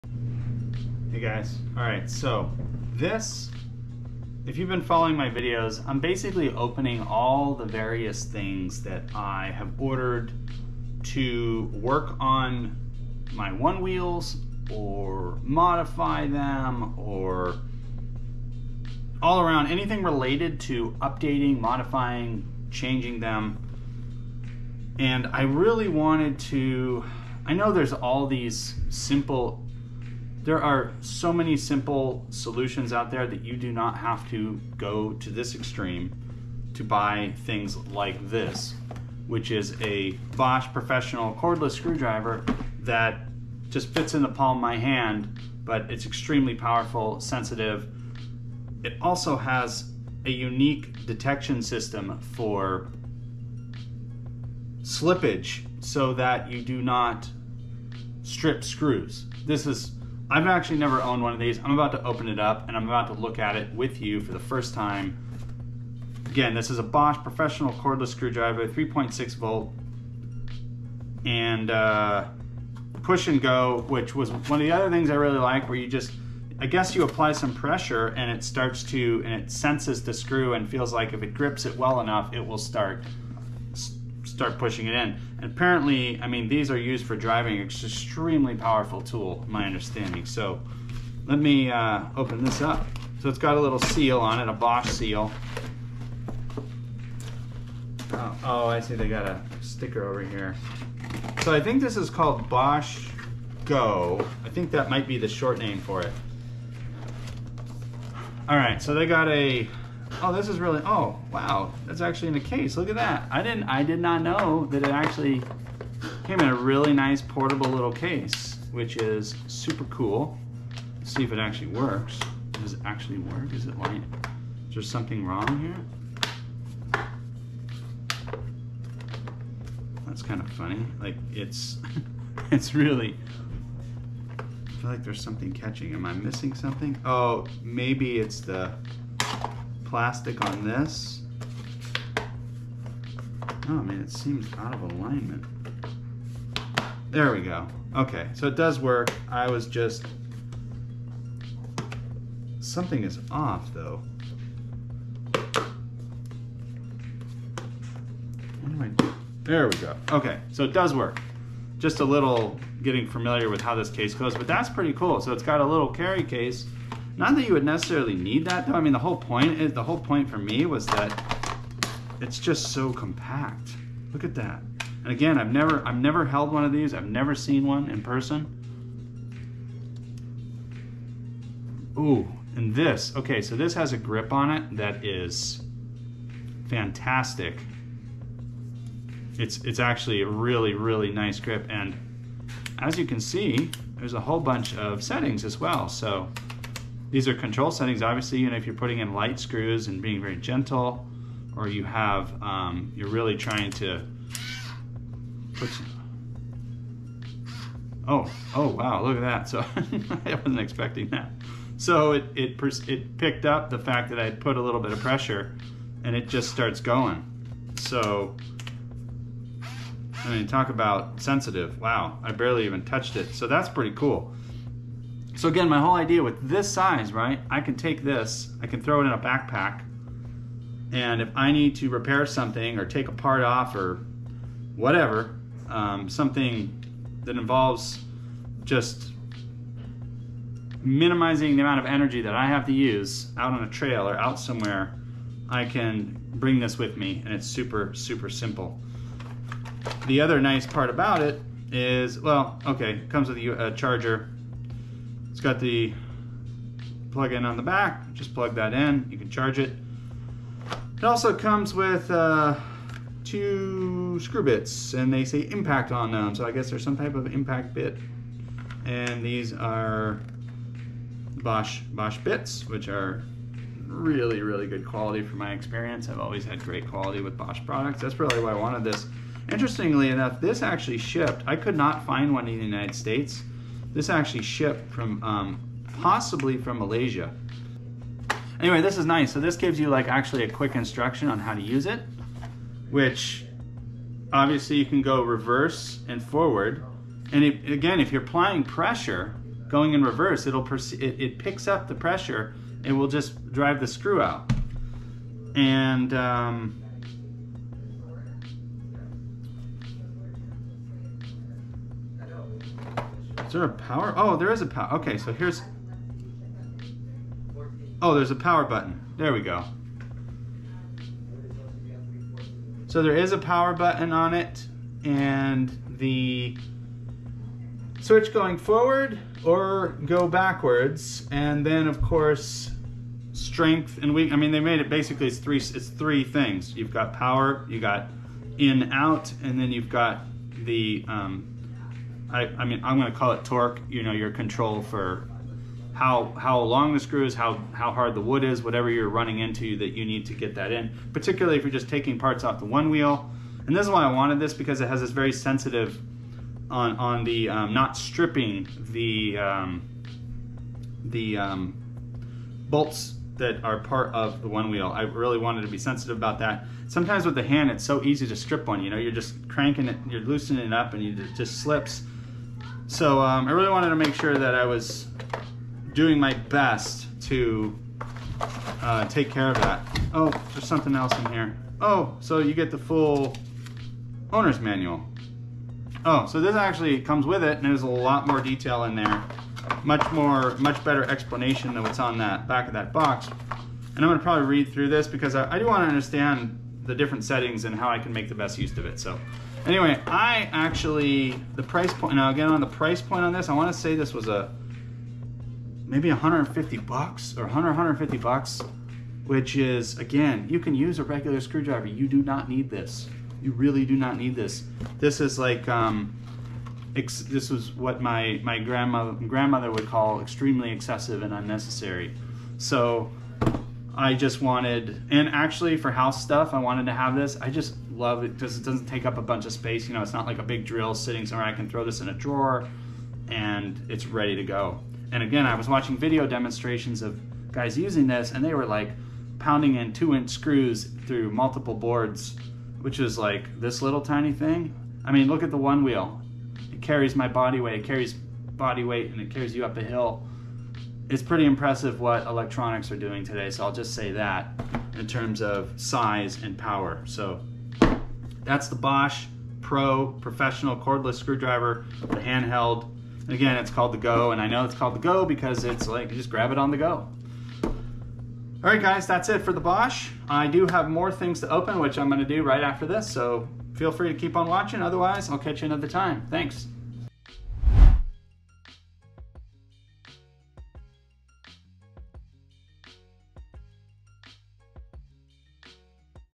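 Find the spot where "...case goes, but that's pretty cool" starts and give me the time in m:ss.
2:43.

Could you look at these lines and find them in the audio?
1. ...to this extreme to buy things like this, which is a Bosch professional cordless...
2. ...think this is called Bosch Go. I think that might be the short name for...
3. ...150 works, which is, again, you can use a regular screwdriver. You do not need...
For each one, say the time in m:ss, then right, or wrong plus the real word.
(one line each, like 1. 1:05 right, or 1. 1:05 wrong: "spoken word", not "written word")
1. 0:35 right
2. 1:41 right
3. 6:47 wrong: "bucks", not "works".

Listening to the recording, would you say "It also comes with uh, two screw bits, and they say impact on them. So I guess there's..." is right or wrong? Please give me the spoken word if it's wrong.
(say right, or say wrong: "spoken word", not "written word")
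right.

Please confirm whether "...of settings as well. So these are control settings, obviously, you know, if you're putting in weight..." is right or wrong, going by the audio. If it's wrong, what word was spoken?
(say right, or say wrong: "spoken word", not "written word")
wrong: "light", not "weight".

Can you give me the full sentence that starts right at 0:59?
This is I've actually never owned one of these.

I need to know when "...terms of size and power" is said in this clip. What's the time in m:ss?
7:35.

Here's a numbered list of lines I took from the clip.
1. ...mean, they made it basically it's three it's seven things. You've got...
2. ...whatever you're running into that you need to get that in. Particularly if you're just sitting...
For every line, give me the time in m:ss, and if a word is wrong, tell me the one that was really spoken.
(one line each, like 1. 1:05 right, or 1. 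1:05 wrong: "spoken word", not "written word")
1. 5:34 wrong: "three", not "seven"
2. 5:48 wrong: "taking", not "sitting".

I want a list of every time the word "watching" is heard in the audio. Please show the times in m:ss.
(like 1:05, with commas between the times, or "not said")
7:15, 7:54.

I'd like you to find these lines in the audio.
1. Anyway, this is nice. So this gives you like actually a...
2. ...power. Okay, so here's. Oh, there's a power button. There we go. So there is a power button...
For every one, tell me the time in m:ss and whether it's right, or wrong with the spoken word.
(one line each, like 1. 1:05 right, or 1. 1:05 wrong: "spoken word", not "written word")
1. 4:48 right
2. 5:14 right.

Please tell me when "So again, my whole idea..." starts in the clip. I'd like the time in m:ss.
3:45.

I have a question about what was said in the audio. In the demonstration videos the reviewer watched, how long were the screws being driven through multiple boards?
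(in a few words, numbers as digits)
2 inch.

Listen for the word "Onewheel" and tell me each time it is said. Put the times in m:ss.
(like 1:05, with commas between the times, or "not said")
0:13, 5:52, 6:04, 7:25.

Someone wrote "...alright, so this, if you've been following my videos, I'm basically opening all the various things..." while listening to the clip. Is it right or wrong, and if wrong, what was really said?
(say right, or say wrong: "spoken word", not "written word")
right.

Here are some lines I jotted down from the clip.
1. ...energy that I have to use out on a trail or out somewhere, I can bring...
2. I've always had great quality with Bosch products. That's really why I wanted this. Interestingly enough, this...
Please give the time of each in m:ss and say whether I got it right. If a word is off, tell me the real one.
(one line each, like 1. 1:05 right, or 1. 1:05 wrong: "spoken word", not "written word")
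1. 4:01 right
2. 4:36 right.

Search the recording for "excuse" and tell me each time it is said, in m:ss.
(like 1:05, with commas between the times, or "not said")
not said.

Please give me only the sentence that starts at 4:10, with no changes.
The other nice part about it is, well, okay, comes with a charger, it's got the plug-in on the back.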